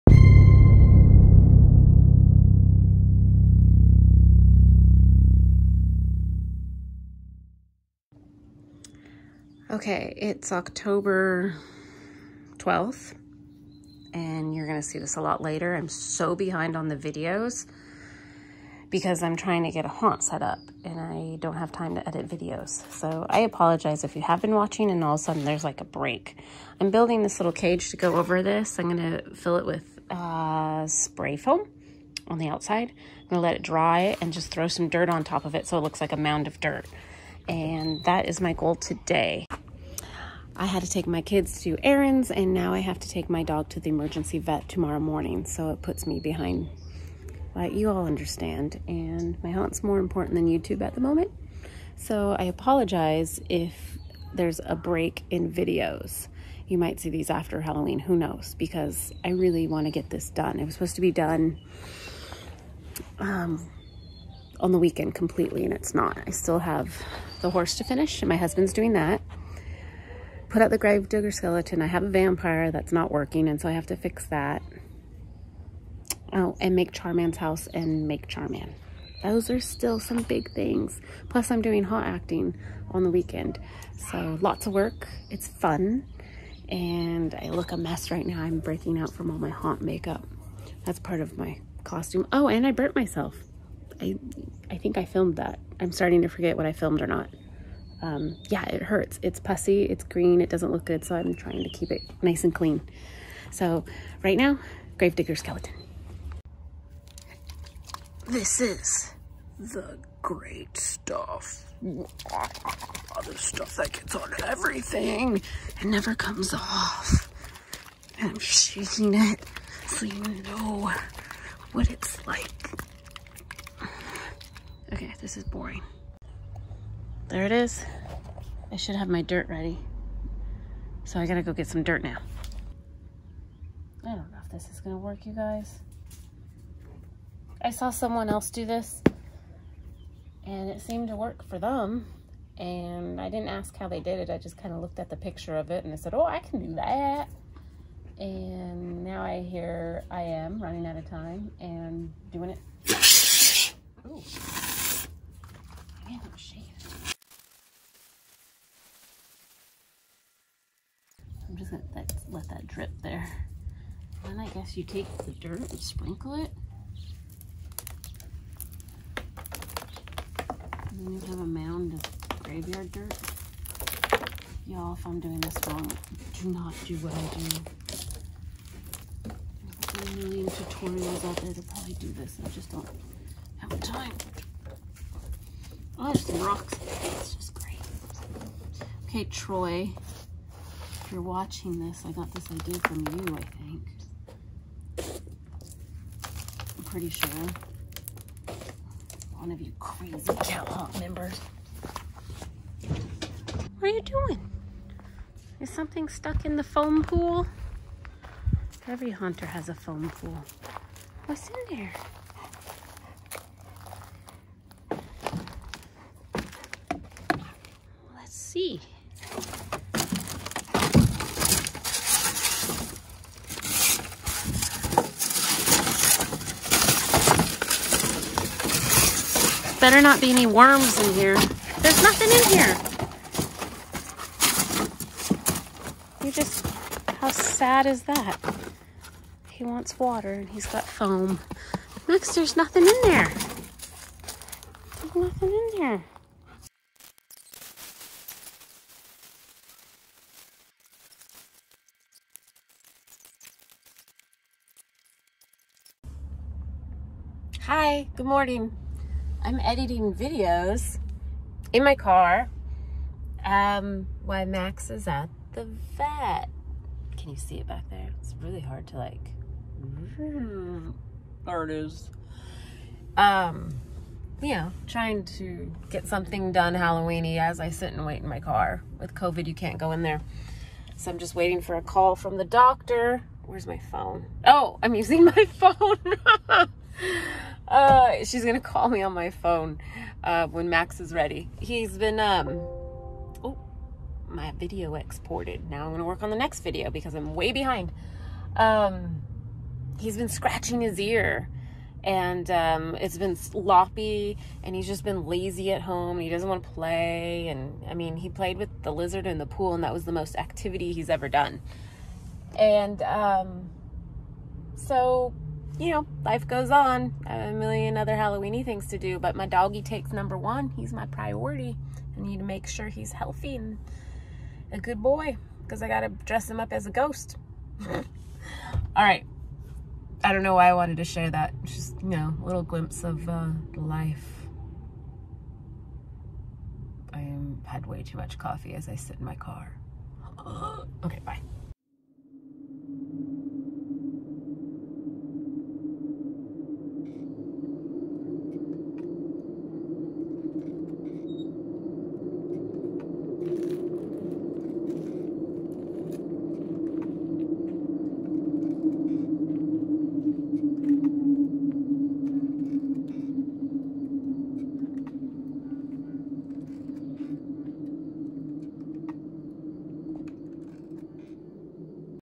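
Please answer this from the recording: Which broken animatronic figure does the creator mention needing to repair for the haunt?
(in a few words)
Vampire.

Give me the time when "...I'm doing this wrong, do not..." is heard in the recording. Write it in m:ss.
2:55.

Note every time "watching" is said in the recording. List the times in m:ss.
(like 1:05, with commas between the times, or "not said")
0:24, 3:11.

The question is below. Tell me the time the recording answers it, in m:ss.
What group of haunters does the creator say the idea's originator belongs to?
3:20.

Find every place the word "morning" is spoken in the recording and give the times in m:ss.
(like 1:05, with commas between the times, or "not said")
0:44, 4:18.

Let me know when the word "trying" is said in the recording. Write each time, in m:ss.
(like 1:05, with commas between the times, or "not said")
0:19, 1:41, 4:34.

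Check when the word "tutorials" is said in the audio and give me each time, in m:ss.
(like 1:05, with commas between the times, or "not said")
3:00.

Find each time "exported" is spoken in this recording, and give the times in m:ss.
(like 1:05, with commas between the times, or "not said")
4:54.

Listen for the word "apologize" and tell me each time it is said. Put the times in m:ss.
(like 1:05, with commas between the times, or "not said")
0:23, 0:52.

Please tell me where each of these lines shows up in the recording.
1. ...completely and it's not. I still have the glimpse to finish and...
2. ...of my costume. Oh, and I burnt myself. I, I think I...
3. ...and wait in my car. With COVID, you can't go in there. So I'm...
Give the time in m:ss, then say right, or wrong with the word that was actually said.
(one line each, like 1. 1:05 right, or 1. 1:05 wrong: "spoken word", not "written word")
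1. 1:05 wrong: "horse", not "glimpse"
2. 1:31 right
3. 4:37 right.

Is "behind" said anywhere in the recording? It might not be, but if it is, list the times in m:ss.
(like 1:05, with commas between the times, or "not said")
0:16, 0:46, 4:57.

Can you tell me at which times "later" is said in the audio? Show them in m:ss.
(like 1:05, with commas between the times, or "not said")
0:15.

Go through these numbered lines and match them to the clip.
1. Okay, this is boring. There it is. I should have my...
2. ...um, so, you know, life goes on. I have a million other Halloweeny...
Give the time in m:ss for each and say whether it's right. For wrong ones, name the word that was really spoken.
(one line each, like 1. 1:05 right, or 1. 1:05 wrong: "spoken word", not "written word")
1. 2:04 right
2. 5:13 right.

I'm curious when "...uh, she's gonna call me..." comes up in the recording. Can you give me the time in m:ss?
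4:47.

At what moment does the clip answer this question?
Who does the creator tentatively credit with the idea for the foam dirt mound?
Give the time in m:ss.
3:09.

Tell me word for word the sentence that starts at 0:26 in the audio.
I'm building this little cage to go over this.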